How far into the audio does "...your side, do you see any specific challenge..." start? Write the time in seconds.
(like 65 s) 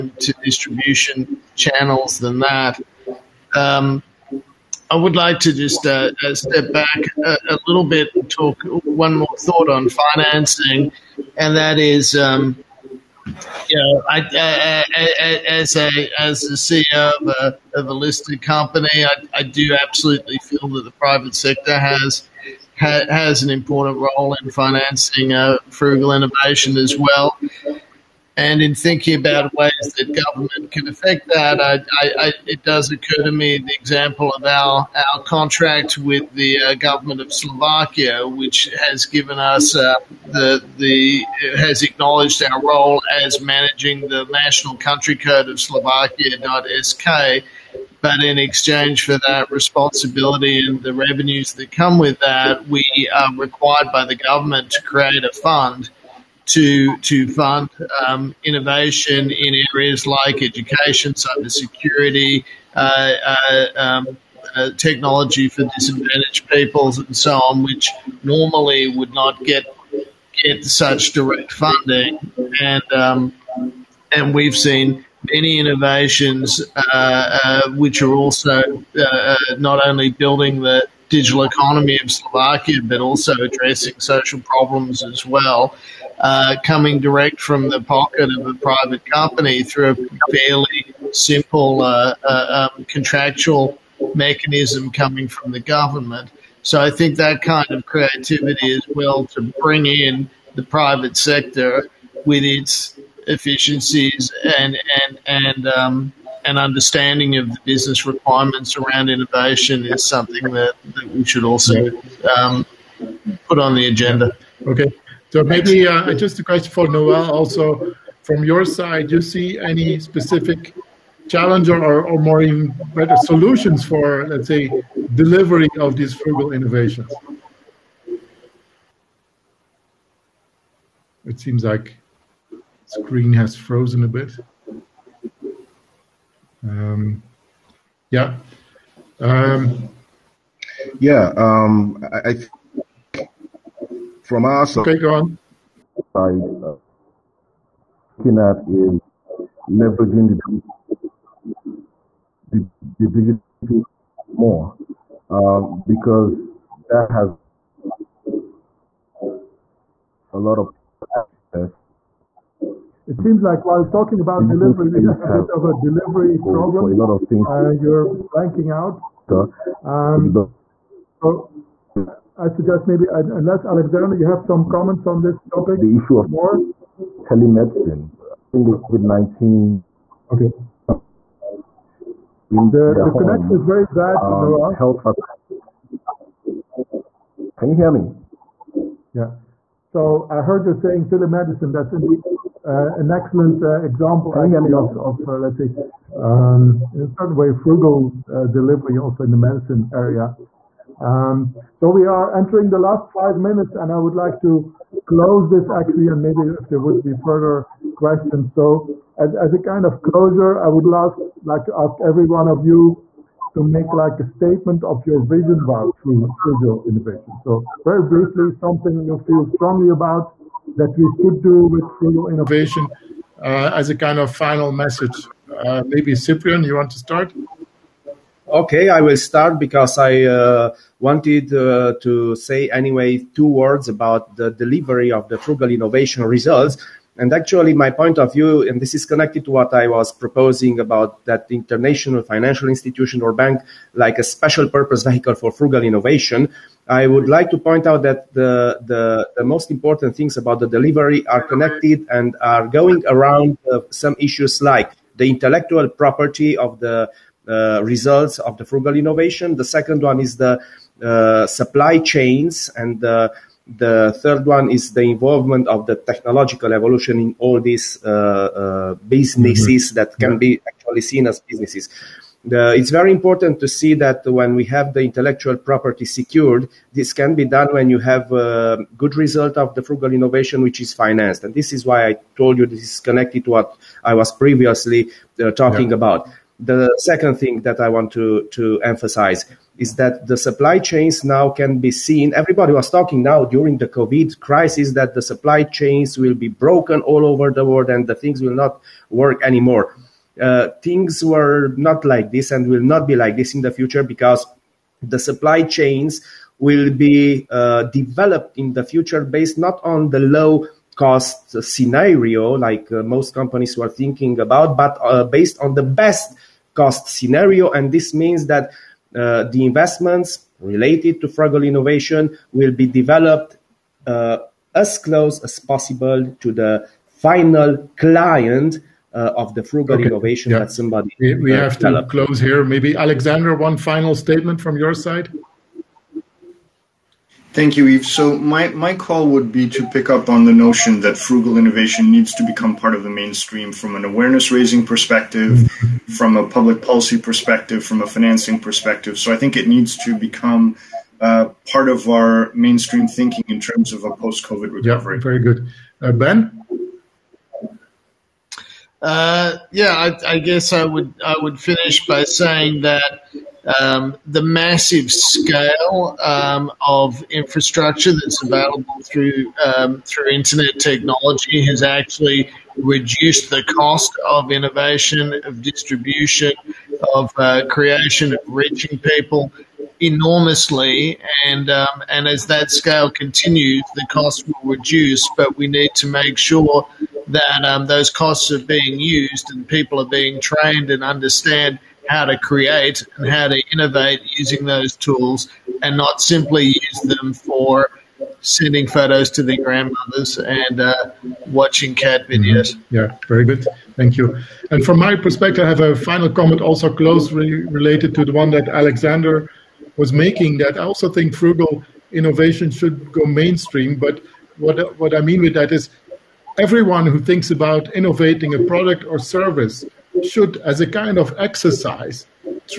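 118 s.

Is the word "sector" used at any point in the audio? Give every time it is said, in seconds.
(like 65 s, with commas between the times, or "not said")
21 s, 101 s.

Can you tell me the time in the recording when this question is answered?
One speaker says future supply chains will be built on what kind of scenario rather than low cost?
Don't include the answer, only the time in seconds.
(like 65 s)
315 s.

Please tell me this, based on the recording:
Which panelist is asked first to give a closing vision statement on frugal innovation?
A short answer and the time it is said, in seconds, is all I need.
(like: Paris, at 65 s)
Ciprian, at 226 s.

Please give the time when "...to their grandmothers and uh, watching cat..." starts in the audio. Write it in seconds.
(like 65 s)
399 s.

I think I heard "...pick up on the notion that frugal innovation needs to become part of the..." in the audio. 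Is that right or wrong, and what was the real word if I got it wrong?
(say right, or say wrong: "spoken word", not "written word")
right.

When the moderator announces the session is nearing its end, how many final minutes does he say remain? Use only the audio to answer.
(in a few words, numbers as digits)
5.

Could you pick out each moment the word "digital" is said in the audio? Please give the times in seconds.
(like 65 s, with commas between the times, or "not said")
81 s, 153 s, 164 s.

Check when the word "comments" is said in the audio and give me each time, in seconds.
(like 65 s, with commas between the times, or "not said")
174 s, 406 s.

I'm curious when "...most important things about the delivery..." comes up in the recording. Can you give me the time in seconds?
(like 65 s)
249 s.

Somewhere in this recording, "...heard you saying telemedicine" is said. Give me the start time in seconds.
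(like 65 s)
190 s.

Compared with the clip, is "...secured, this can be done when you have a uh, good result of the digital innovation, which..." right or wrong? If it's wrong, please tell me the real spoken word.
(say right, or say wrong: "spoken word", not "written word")
wrong: "frugal", not "digital".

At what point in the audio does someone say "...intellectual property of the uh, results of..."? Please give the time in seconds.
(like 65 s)
255 s.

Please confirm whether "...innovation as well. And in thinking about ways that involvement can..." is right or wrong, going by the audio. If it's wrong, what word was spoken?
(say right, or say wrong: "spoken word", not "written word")
wrong: "government", not "involvement".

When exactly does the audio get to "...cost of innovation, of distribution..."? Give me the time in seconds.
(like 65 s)
373 s.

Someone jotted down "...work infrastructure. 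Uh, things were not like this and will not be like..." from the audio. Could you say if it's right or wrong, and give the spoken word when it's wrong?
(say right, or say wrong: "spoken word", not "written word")
wrong: "anymore", not "infrastructure".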